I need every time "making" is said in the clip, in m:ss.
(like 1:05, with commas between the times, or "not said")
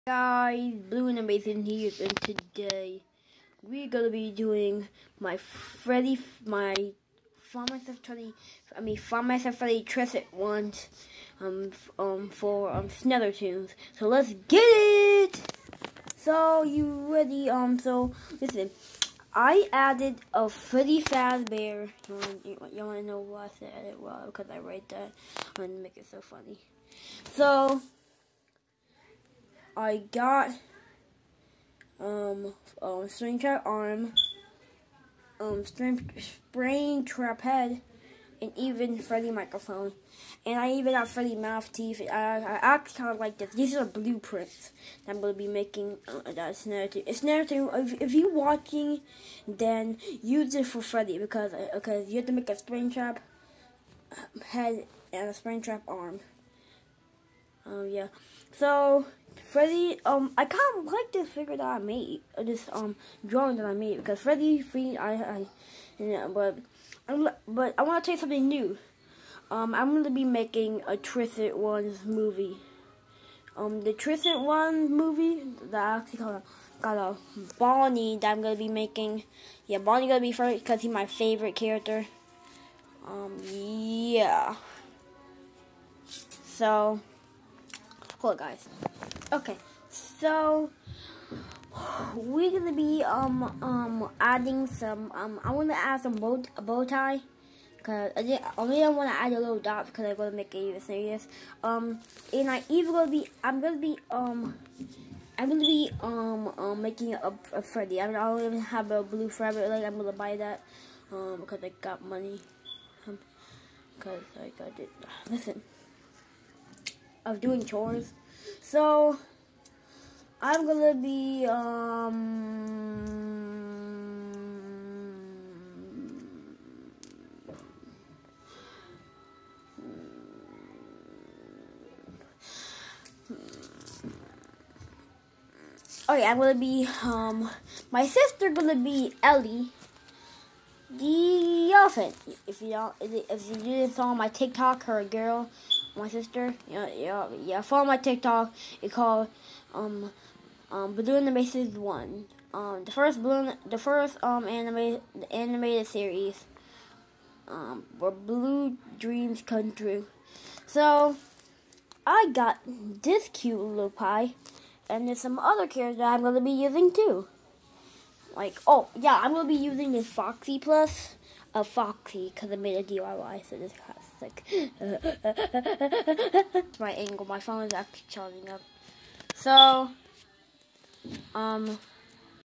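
0:45, 1:10, 1:18, 1:46.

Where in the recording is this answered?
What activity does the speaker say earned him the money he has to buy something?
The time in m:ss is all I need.
1:57.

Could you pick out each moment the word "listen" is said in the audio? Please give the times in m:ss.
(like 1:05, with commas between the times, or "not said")
0:18, 1:55.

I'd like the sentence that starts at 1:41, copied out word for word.
Um, and I even gonna be I'm gonna be um.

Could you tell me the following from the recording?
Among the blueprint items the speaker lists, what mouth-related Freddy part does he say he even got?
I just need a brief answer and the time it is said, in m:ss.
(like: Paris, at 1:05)
Freddy mouth teeth, at 0:41.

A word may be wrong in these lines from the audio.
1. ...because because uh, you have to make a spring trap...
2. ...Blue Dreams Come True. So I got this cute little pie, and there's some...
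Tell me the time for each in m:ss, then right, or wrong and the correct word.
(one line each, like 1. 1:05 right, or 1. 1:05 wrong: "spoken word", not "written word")
1. 0:51 right
2. 2:38 right.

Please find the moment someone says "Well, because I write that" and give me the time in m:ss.
0:23.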